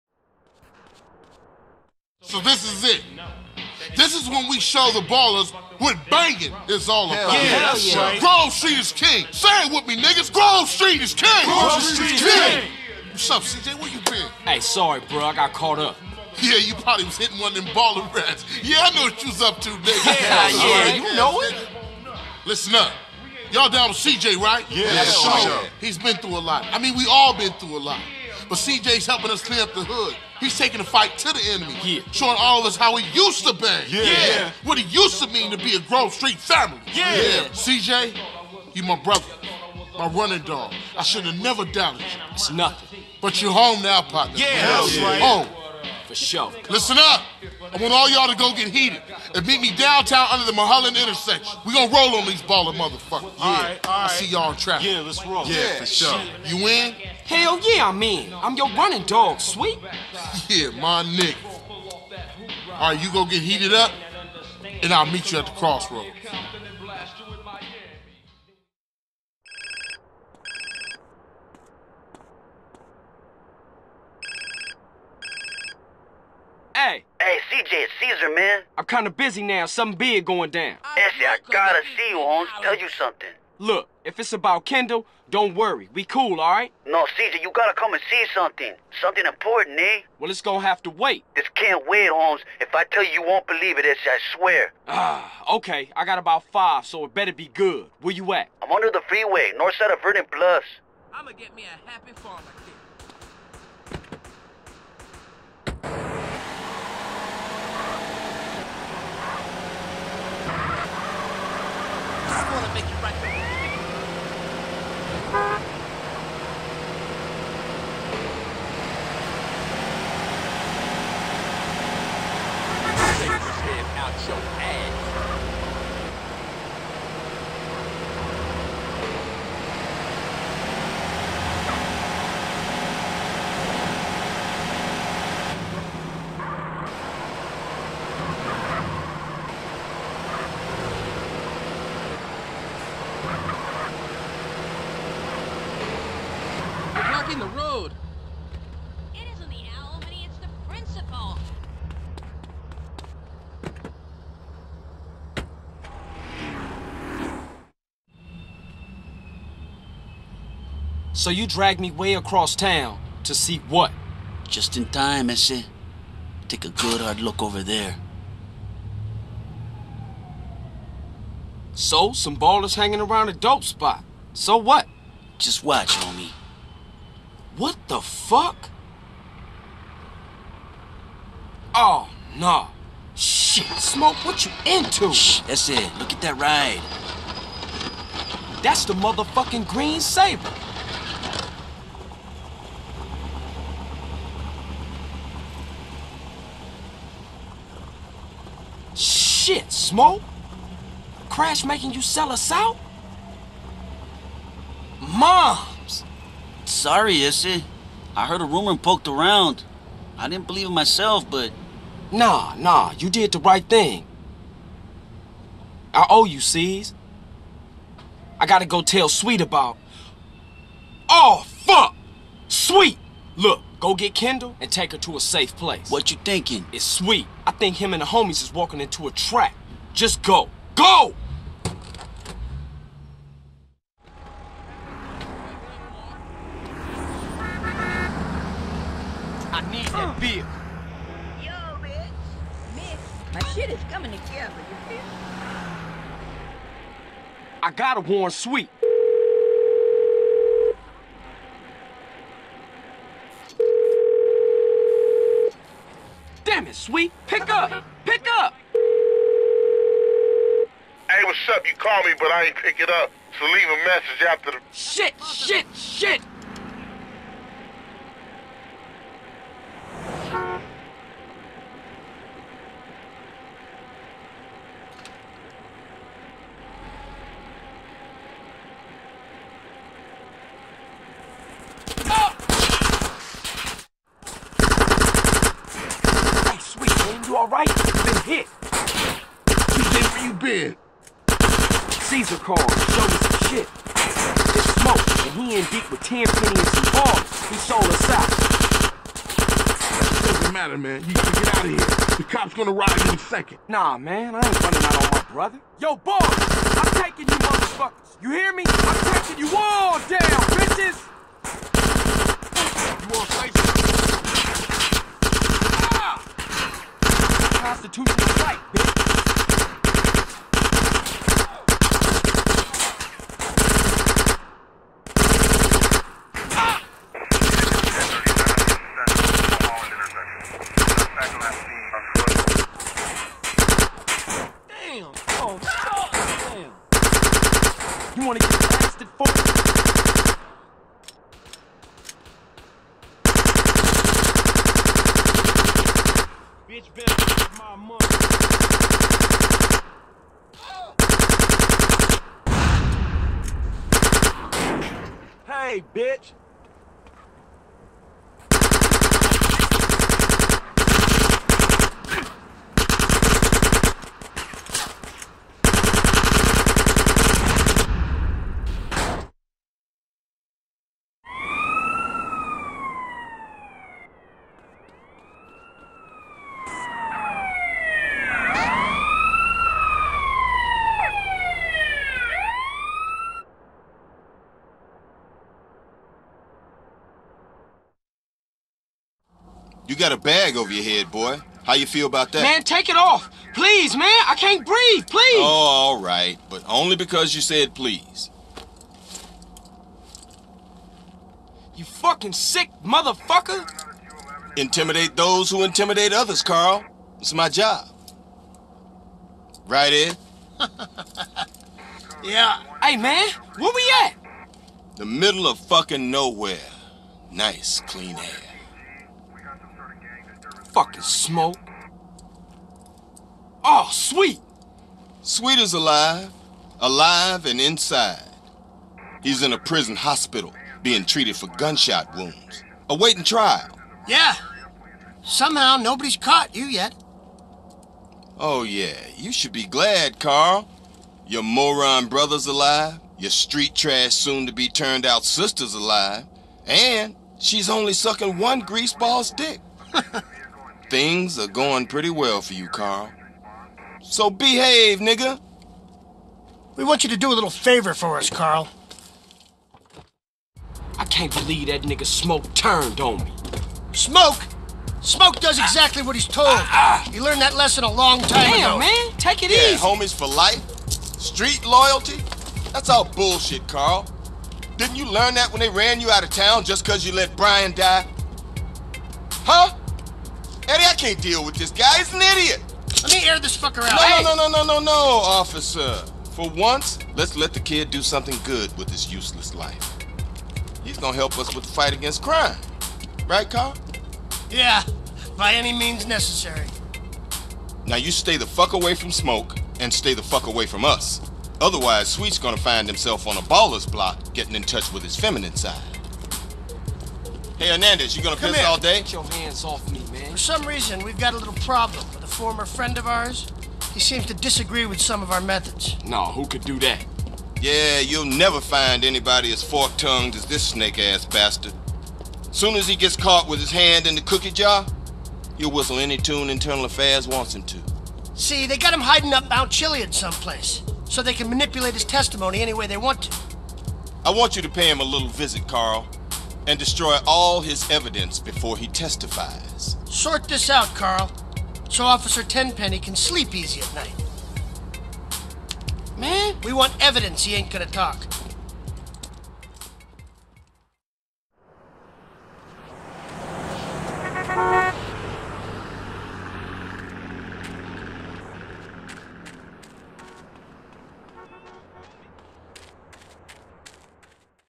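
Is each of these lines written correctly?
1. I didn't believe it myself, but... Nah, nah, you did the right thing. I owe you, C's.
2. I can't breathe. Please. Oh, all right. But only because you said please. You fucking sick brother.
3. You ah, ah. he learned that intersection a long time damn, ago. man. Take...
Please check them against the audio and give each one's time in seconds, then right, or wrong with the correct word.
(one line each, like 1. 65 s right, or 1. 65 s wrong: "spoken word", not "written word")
1. 210 s right
2. 394 s wrong: "motherfucker", not "brother"
3. 466 s wrong: "lesson", not "intersection".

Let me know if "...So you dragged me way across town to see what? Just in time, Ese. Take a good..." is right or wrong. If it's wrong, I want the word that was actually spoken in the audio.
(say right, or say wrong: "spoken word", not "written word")
right.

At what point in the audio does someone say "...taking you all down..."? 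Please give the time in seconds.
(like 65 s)
309 s.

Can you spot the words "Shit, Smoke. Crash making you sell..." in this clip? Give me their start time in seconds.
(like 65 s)
198 s.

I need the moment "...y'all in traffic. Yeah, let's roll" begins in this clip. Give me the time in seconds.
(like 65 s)
54 s.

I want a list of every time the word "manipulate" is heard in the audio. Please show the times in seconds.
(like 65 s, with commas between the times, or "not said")
531 s.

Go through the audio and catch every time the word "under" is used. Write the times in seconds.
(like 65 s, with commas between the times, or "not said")
50 s, 98 s.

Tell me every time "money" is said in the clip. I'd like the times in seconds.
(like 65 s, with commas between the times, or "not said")
347 s.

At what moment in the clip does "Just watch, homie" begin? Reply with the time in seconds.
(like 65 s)
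175 s.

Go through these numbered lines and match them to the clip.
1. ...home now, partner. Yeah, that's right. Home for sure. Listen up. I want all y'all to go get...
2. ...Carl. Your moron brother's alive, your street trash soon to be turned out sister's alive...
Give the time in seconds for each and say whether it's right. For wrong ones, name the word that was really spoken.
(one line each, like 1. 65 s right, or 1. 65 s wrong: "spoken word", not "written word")
1. 43 s right
2. 440 s right.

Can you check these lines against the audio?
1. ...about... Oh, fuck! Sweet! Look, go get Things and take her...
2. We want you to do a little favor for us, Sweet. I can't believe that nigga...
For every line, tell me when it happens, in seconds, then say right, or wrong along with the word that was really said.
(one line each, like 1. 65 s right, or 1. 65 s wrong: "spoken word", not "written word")
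1. 219 s wrong: "Kendl", not "Things"
2. 456 s wrong: "Carl", not "Sweet".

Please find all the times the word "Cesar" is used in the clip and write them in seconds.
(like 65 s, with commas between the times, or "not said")
77 s, 291 s.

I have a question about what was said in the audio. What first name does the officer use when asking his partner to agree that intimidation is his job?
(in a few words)
Ed.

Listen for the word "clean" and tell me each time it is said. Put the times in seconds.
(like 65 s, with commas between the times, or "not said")
29 s, 417 s.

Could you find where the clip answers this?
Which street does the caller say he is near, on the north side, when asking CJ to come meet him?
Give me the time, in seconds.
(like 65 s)
100 s.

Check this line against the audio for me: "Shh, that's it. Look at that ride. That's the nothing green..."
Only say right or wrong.
wrong.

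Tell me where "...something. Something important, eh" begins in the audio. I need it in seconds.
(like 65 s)
88 s.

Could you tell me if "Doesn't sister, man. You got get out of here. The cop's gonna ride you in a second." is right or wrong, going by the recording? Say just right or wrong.
wrong.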